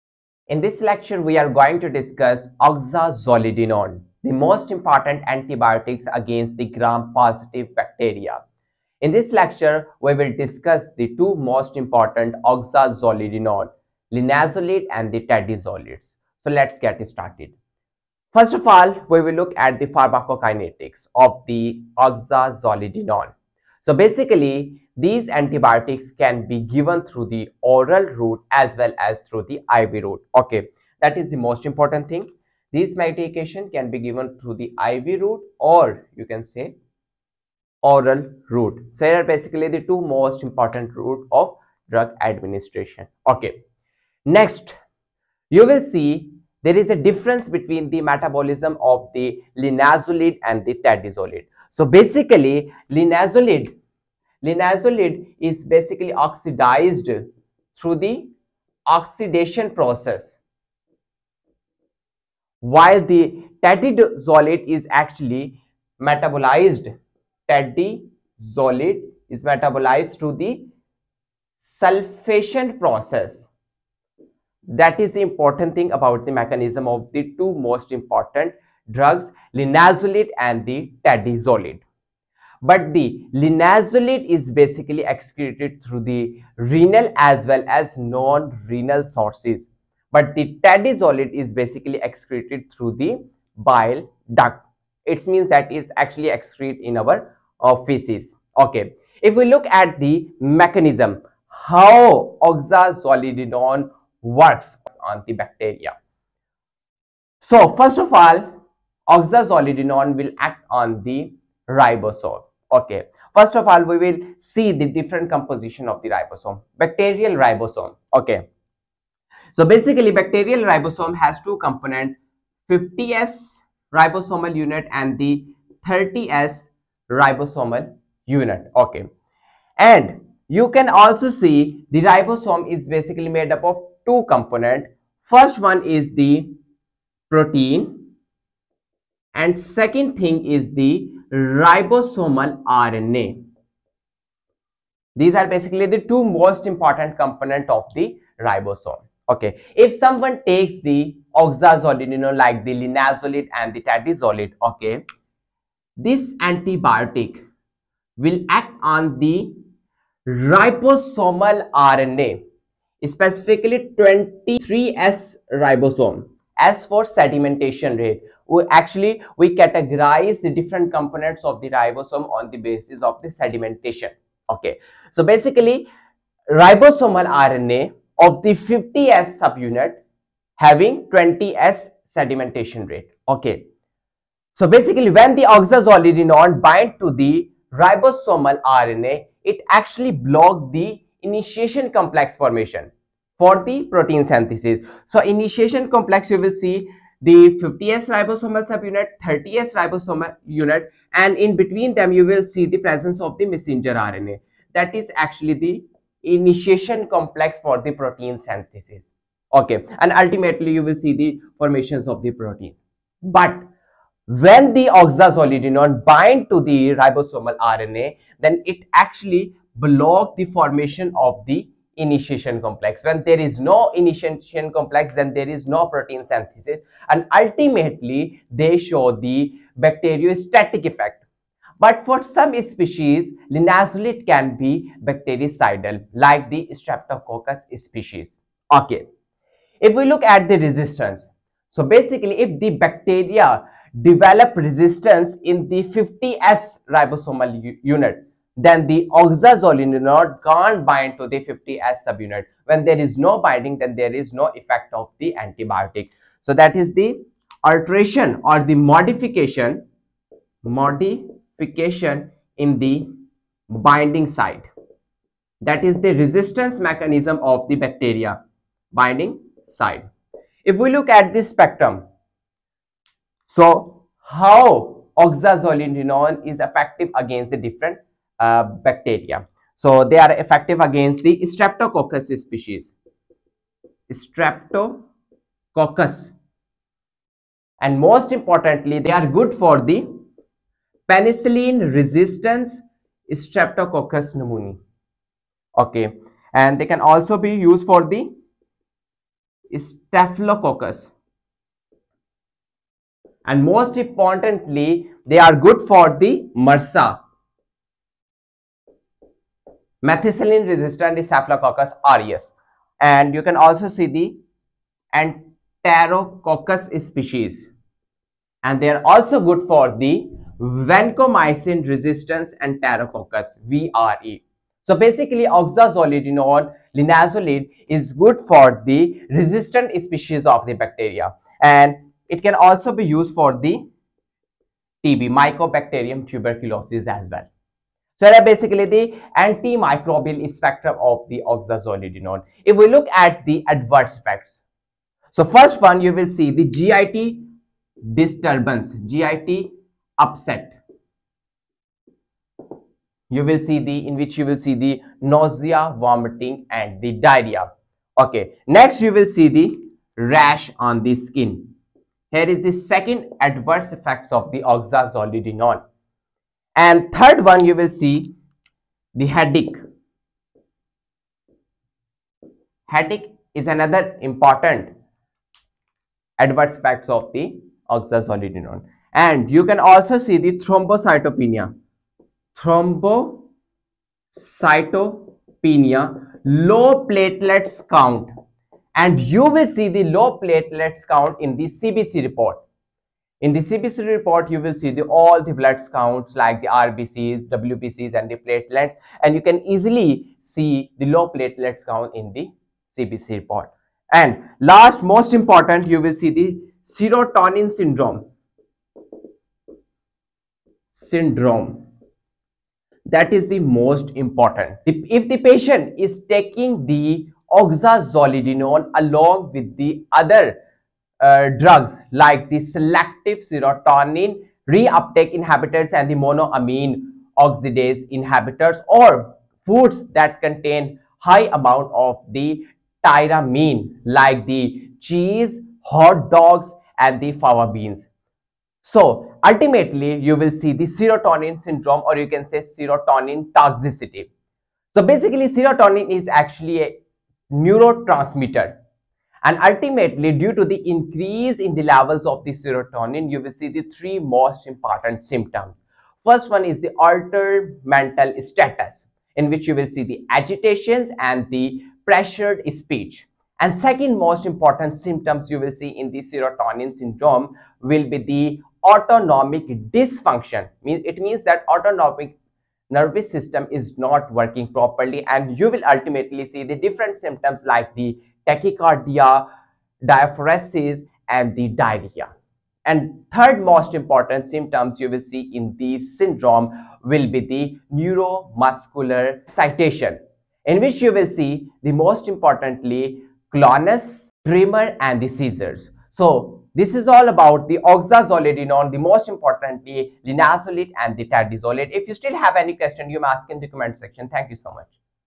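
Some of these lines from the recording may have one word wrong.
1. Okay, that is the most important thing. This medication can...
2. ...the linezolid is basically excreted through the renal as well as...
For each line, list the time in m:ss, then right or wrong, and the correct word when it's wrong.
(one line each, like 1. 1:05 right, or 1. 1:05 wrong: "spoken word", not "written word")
1. 0:30 right
2. 1:22 right.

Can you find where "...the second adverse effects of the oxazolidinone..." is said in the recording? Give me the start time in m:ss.
6:02.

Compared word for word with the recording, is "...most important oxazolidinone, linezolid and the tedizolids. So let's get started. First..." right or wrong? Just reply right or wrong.
right.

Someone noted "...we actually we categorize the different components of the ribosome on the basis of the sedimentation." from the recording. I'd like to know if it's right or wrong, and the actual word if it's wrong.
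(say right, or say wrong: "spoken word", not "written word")
right.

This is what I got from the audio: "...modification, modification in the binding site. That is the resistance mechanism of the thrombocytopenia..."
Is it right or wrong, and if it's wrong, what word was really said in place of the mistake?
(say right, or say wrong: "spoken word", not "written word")
wrong: "bacteria", not "thrombocytopenia".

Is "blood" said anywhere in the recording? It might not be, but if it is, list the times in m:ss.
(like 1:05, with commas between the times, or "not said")
6:35.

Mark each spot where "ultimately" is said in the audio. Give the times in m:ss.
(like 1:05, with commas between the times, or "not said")
3:30, 3:47, 7:19, 7:29, 7:55.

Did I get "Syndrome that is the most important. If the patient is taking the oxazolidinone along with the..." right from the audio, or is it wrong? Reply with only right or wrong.
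right.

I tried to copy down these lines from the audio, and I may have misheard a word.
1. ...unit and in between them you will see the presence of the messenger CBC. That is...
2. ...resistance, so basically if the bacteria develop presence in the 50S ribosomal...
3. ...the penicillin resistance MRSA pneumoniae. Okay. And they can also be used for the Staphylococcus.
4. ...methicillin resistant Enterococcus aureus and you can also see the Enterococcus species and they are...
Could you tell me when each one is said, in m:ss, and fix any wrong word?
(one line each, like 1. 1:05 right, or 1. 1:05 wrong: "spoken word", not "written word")
1. 3:20 wrong: "RNA", not "CBC"
2. 4:00 wrong: "resistance", not "presence"
3. 4:49 wrong: "Streptococcus", not "MRSA"
4. 5:10 wrong: "Staphylococcus", not "Enterococcus".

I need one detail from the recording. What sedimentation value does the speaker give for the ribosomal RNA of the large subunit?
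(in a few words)
20S.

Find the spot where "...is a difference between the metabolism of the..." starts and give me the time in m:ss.
0:46.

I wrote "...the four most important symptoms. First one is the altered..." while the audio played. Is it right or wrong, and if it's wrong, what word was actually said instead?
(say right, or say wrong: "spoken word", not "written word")
wrong: "three", not "four".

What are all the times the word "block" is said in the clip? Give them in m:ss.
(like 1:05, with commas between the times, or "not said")
3:10, 3:39.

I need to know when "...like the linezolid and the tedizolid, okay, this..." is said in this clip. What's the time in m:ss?
2:32.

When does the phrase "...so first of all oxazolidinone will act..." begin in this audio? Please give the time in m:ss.
1:47.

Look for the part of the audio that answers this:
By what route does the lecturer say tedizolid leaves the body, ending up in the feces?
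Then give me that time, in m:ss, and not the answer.
1:33.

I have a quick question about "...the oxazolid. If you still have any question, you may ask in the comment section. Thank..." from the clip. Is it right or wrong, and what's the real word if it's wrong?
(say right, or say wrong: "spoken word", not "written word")
wrong: "tedizolid", not "oxazolid".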